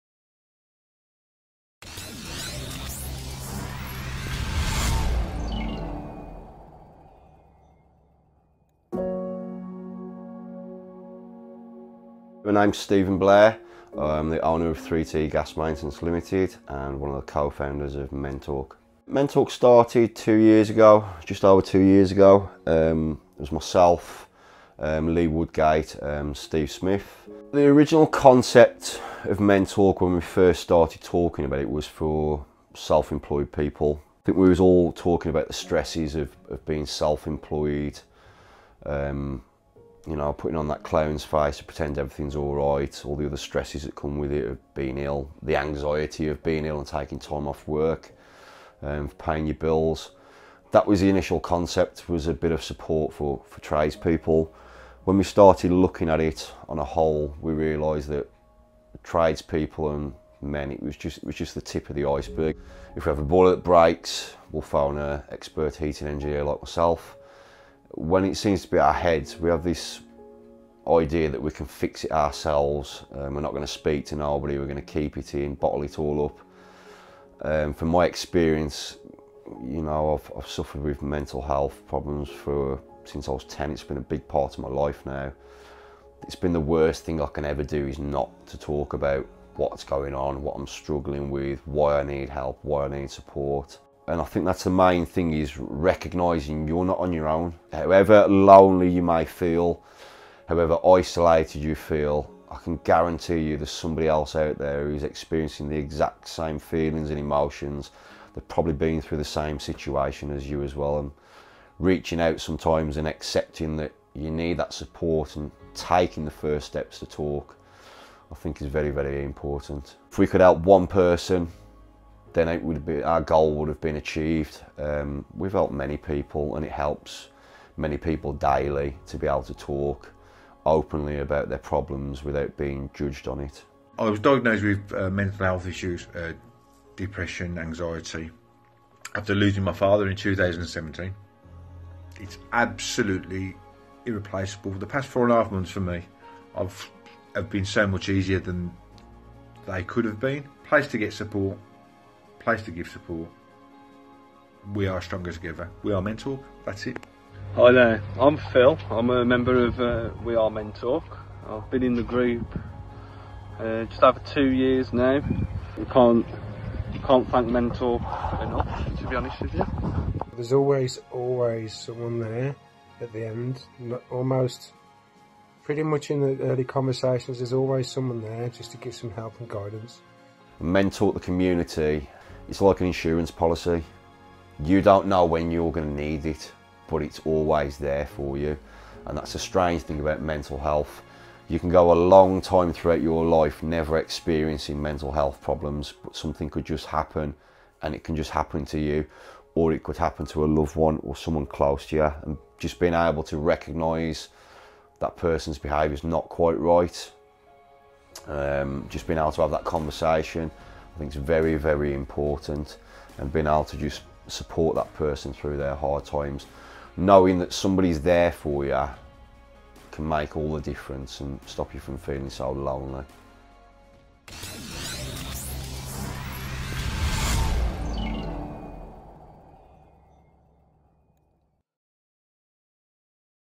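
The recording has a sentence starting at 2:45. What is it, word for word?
We can't you can't thank Mentalk enough, to be honest with you.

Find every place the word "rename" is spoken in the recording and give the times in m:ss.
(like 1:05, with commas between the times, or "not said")
not said.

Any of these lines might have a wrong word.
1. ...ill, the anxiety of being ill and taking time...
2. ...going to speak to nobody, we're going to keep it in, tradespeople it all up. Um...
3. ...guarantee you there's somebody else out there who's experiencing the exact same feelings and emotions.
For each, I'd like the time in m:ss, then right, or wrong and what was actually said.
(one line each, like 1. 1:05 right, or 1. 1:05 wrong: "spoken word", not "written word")
1. 0:44 right
2. 1:13 wrong: "bottle", not "tradespeople"
3. 1:42 right.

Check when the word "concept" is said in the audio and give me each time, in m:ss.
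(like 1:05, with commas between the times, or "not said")
0:28, 0:51.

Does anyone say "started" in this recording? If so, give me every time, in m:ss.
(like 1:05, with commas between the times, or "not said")
0:19, 0:30, 0:55.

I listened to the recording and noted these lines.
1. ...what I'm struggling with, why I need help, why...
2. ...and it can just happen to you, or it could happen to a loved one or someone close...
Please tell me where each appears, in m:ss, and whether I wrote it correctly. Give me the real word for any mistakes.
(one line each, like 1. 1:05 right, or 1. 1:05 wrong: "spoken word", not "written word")
1. 1:30 right
2. 3:17 right.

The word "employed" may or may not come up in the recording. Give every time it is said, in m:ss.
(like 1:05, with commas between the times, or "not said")
0:32, 0:36.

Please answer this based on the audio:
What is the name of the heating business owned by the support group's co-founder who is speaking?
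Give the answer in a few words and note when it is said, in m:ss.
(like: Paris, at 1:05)
3T Gas Maintenance Limited, at 0:14.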